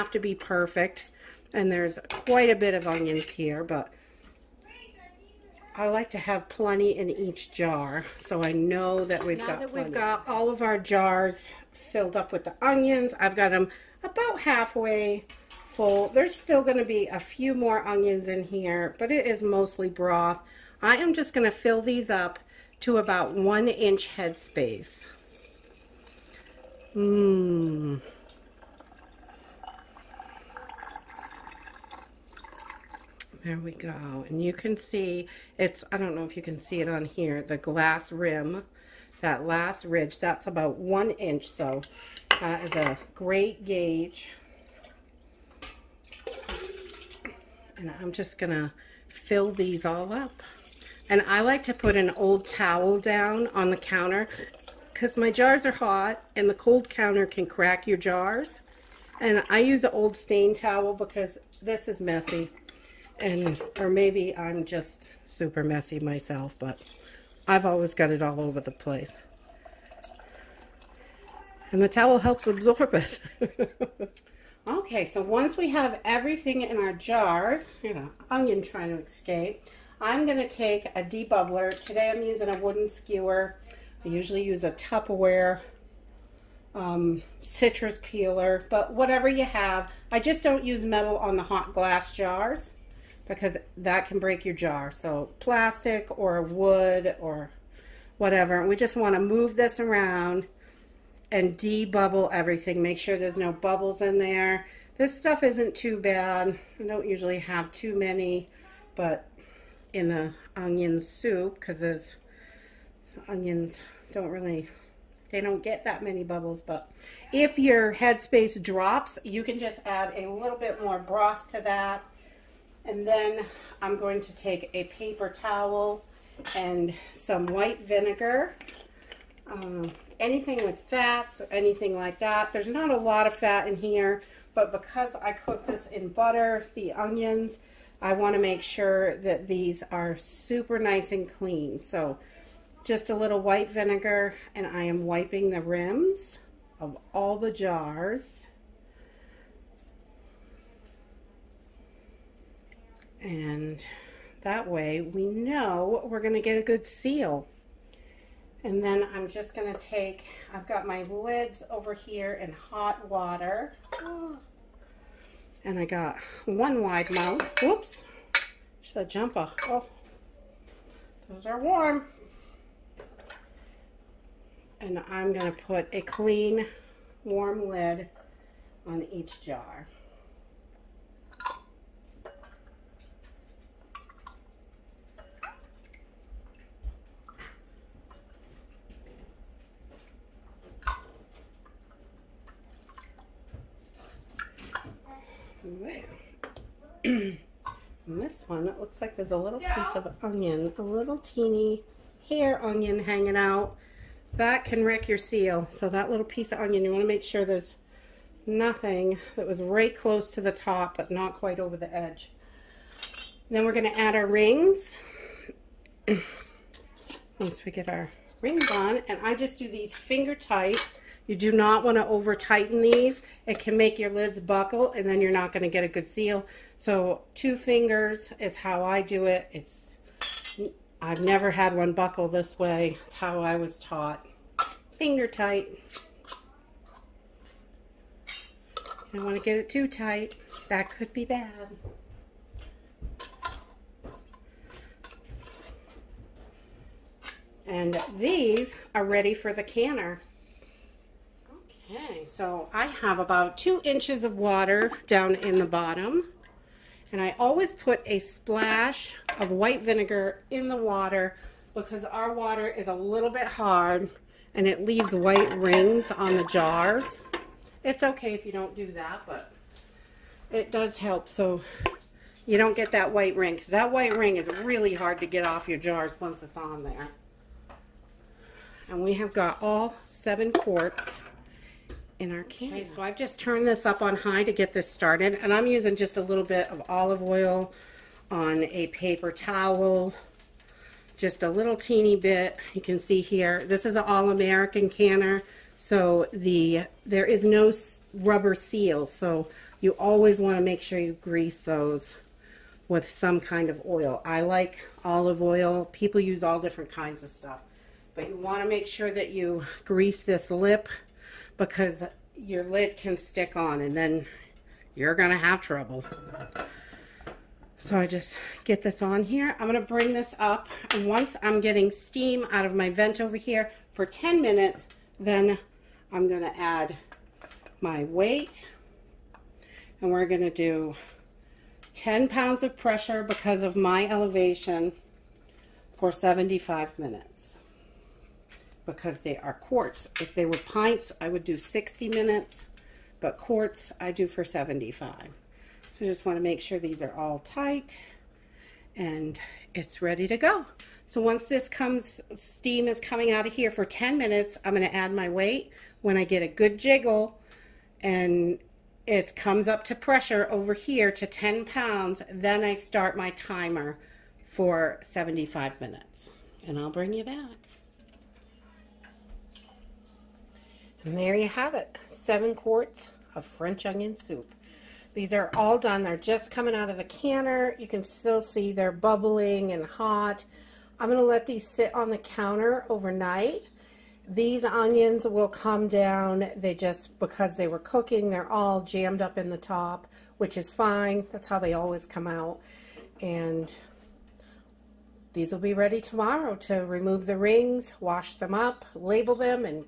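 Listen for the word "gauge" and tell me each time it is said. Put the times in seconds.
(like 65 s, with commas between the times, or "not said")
43 s.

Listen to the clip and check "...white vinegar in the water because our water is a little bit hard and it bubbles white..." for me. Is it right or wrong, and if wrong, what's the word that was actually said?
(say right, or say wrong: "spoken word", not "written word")
wrong: "leaves", not "bubbles".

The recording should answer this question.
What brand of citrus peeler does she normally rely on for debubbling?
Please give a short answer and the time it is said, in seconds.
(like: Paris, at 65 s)
Tupperware, at 84 s.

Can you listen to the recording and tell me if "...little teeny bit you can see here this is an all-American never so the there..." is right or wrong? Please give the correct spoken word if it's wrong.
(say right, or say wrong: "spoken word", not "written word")
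wrong: "canner", not "never".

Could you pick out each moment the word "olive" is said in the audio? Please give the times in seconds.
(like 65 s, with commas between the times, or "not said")
286 s, 305 s.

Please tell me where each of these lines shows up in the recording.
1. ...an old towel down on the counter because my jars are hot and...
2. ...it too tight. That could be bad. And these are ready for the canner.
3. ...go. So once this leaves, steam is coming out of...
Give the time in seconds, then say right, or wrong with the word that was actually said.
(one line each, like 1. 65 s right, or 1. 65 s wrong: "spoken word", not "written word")
1. 51 s right
2. 239 s right
3. 350 s wrong: "comes", not "leaves".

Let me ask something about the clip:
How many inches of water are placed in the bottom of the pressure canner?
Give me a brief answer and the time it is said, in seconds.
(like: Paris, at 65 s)
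2 inches, at 253 s.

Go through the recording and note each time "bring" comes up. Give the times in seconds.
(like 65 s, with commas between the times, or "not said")
319 s, 366 s.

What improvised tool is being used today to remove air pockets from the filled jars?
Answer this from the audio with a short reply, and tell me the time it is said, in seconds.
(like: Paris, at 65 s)
Wooden skewer, at 82 s.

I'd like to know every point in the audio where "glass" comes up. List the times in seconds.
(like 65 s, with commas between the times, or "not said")
37 s, 91 s.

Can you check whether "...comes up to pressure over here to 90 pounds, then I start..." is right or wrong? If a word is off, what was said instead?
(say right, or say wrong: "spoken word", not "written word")
wrong: "10", not "90".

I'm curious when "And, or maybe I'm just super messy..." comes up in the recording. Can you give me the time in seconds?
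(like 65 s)
63 s.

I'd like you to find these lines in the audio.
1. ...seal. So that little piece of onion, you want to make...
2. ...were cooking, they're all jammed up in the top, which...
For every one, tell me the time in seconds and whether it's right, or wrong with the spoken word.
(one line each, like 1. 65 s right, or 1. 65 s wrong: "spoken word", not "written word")
1. 205 s right
2. 387 s right.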